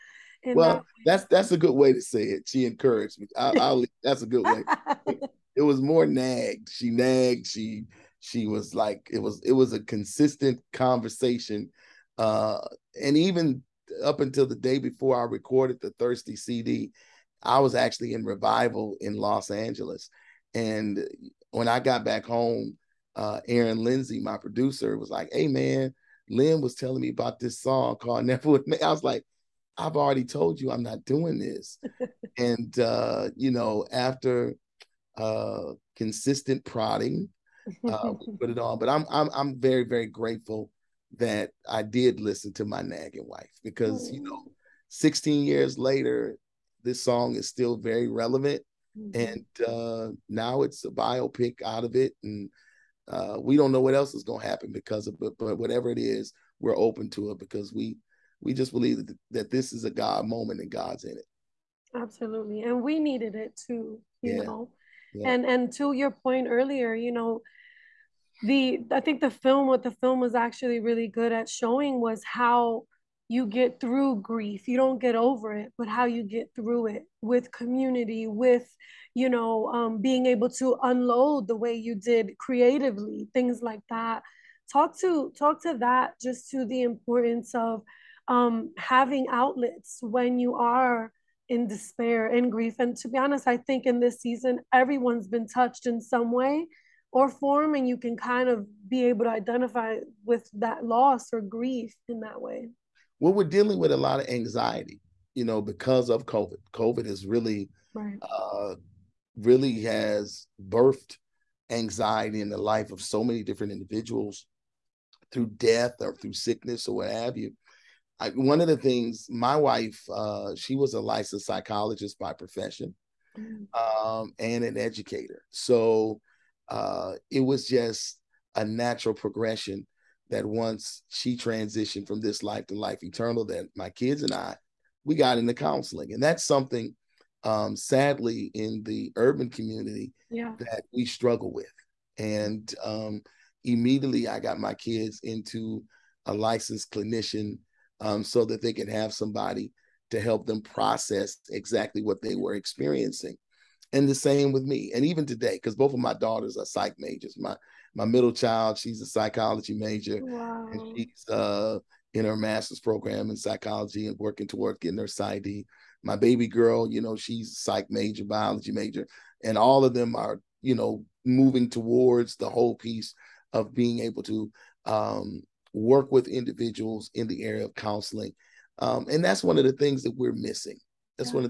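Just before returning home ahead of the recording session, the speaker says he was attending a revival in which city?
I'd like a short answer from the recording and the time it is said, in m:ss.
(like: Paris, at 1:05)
Los Angeles, at 0:19.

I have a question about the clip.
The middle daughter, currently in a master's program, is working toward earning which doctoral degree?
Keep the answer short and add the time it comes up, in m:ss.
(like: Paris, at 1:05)
PsyD, at 2:45.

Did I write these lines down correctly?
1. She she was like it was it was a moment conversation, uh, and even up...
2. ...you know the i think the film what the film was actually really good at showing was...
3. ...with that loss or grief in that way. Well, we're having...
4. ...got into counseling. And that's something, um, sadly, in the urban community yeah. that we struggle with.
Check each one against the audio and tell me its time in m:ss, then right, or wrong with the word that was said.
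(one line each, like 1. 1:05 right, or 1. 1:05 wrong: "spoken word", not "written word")
1. 0:07 wrong: "consistent", not "moment"
2. 1:06 right
3. 1:40 wrong: "dealing", not "having"
4. 2:15 right.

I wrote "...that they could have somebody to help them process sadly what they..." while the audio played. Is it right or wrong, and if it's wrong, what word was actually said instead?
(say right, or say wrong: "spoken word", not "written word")
wrong: "exactly", not "sadly".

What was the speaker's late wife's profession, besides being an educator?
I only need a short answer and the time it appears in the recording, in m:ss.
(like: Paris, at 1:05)
Licensed psychologist, at 2:01.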